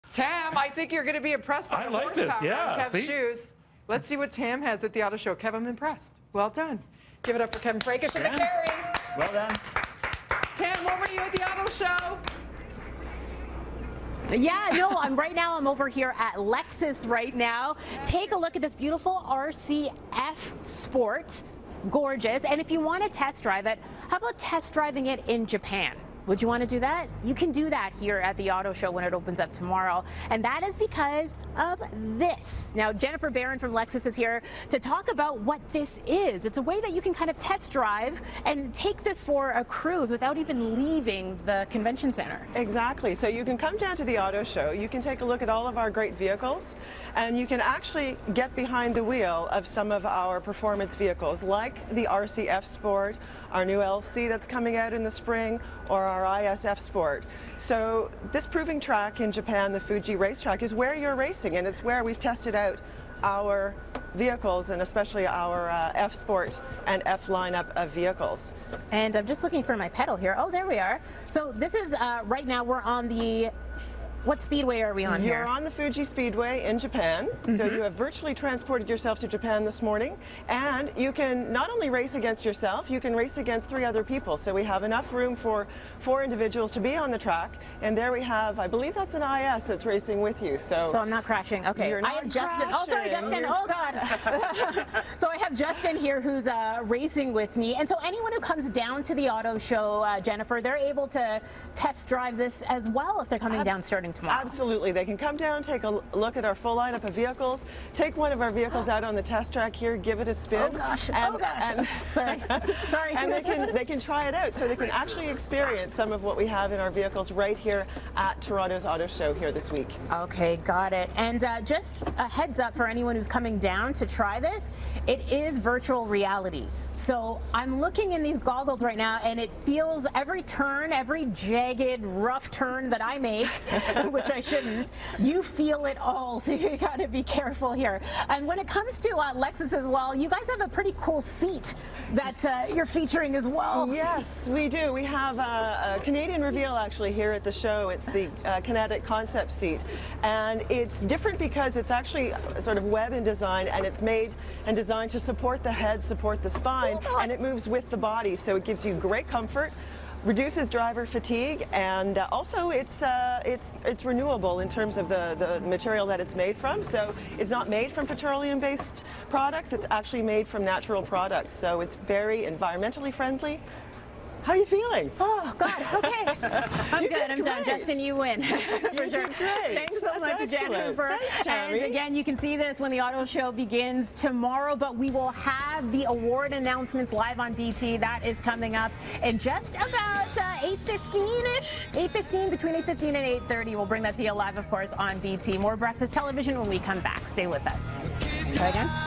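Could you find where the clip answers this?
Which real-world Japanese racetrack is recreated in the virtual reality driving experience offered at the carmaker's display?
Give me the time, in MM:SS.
01:15.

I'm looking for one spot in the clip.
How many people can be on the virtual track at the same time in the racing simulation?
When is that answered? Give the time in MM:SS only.
01:25.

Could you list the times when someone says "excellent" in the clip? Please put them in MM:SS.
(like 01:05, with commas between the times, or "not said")
03:00.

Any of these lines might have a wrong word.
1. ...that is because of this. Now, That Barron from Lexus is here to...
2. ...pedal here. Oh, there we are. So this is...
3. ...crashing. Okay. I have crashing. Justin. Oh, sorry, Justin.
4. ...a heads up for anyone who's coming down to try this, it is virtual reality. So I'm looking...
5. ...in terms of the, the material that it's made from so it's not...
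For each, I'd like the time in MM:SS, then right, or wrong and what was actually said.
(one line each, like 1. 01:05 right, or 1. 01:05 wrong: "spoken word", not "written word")
1. 00:30 wrong: "Jennifer", not "That"
2. 01:09 right
3. 01:31 right
4. 02:02 right
5. 02:44 right.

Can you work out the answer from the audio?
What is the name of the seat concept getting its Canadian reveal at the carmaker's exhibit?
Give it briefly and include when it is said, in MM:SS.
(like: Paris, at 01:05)
Kinetic Concept Seat, at 02:28.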